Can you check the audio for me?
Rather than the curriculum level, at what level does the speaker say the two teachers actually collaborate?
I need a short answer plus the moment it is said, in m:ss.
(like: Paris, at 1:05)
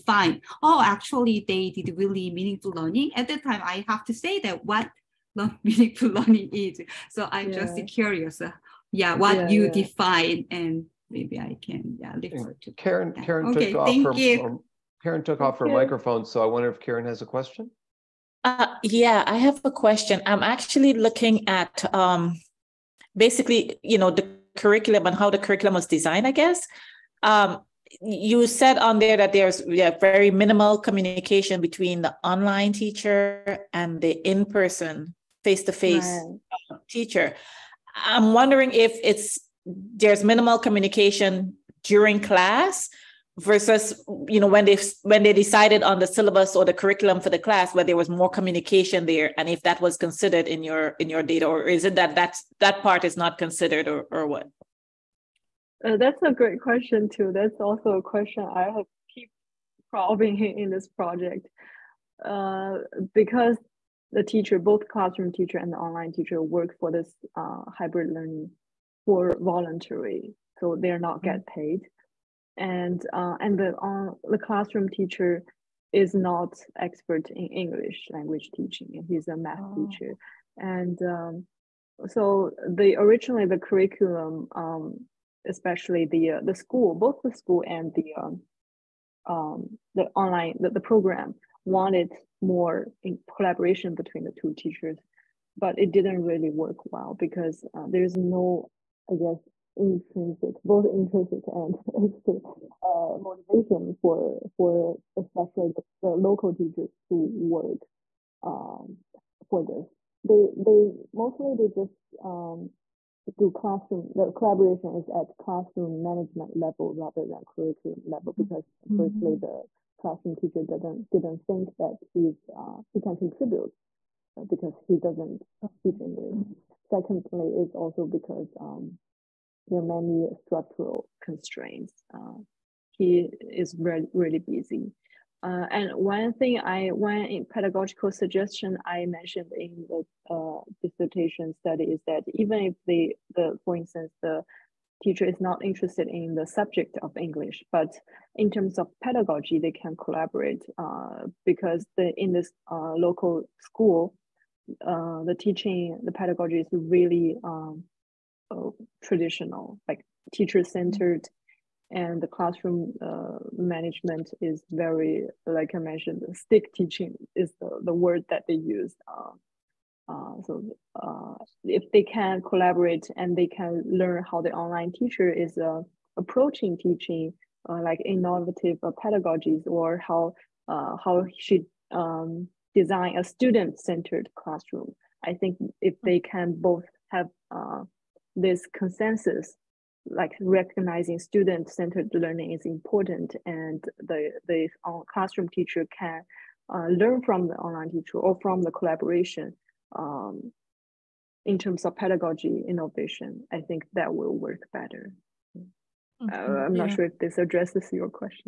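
Classroom management, at 1:55.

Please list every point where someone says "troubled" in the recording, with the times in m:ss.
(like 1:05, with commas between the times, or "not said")
not said.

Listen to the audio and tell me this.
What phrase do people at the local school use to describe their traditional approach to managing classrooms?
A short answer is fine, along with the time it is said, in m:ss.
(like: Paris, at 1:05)
Stick teaching, at 2:46.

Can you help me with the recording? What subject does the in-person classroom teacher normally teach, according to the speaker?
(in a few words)
Math.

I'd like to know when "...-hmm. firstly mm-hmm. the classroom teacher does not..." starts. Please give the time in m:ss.
1:58.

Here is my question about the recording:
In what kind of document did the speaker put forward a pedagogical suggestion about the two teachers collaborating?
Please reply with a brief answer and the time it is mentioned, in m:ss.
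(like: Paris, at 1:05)
Dissertation, at 2:20.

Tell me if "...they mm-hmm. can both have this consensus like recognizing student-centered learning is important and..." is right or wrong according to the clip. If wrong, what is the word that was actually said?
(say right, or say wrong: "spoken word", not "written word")
right.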